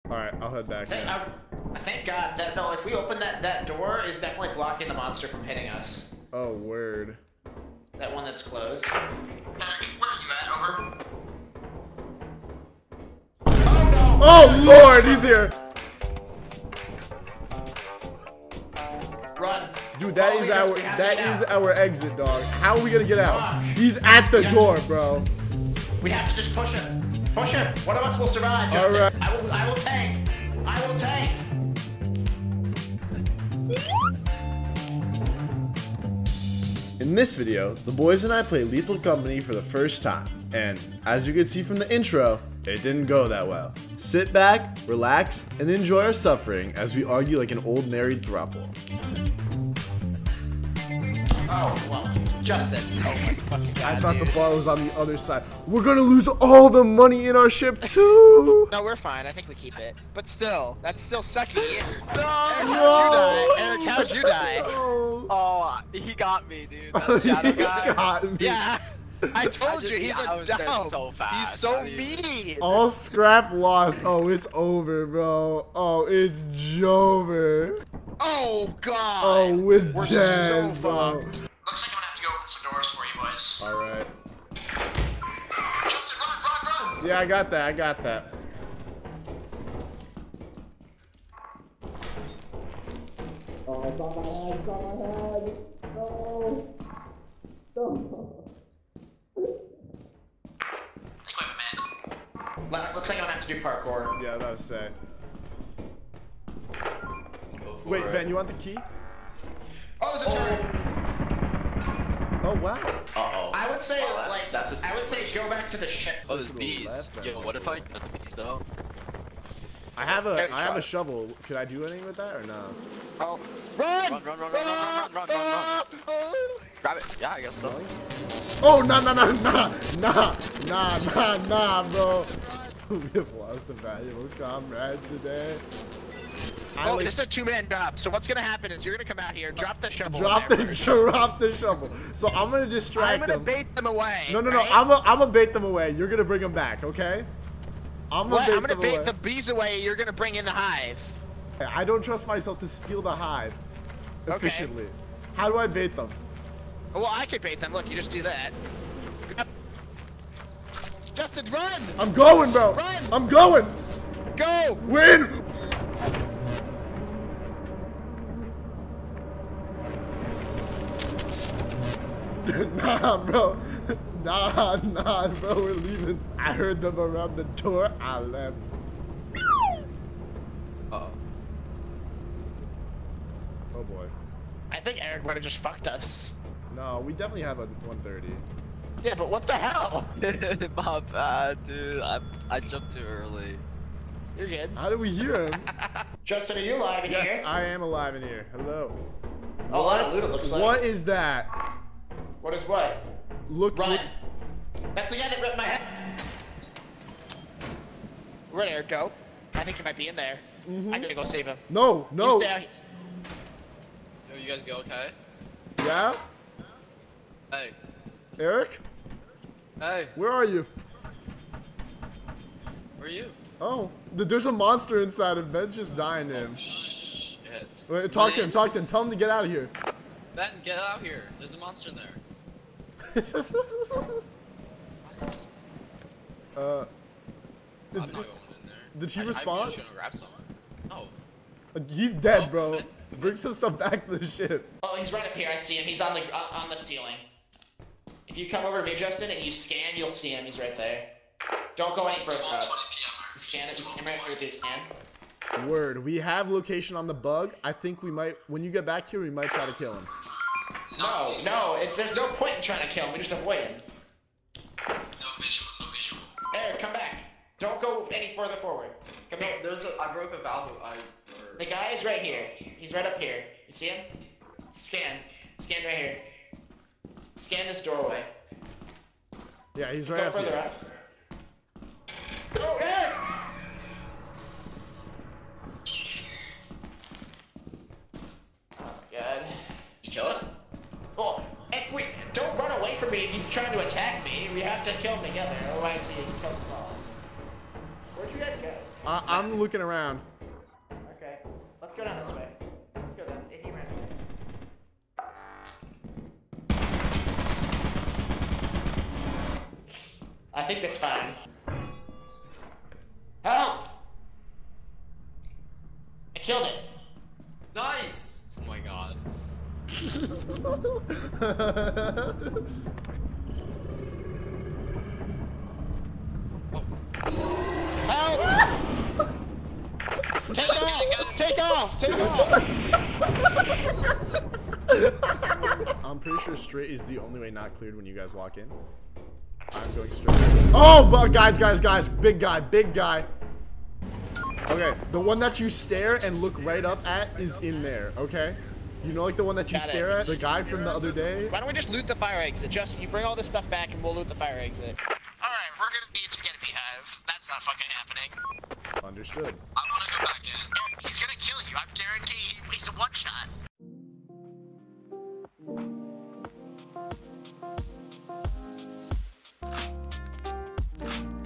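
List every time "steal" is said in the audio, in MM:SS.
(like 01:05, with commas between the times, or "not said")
02:32.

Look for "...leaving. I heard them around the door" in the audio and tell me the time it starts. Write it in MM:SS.
02:55.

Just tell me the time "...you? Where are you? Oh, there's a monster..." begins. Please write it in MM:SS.
03:40.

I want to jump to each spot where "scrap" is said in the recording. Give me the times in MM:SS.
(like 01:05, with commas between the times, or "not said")
01:12.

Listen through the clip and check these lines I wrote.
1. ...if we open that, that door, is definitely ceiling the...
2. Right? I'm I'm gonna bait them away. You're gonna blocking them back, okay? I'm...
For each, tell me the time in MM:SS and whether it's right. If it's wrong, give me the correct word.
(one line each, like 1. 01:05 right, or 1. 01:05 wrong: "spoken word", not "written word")
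1. 00:02 wrong: "blocking", not "ceiling"
2. 02:24 wrong: "bring", not "blocking".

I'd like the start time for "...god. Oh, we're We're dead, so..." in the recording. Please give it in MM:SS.
01:18.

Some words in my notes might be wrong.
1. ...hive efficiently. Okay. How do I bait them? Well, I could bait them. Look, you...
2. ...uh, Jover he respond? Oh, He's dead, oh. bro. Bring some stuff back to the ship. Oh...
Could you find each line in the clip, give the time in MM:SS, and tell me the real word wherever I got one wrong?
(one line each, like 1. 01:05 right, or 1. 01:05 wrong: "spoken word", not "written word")
1. 02:33 right
2. 03:56 wrong: "Did", not "Jover".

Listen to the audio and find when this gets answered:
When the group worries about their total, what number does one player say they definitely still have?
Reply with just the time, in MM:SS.
03:07.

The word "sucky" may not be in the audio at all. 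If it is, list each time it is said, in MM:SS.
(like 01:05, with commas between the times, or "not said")
01:01.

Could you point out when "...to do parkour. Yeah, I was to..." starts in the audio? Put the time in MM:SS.
01:43.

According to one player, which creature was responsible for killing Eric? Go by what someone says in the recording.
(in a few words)
That shadow guy.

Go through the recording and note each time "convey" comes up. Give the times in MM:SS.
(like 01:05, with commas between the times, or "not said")
not said.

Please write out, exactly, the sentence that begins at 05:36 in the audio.
I'm pretty sure straight is the only way not cleared when you guys walk in.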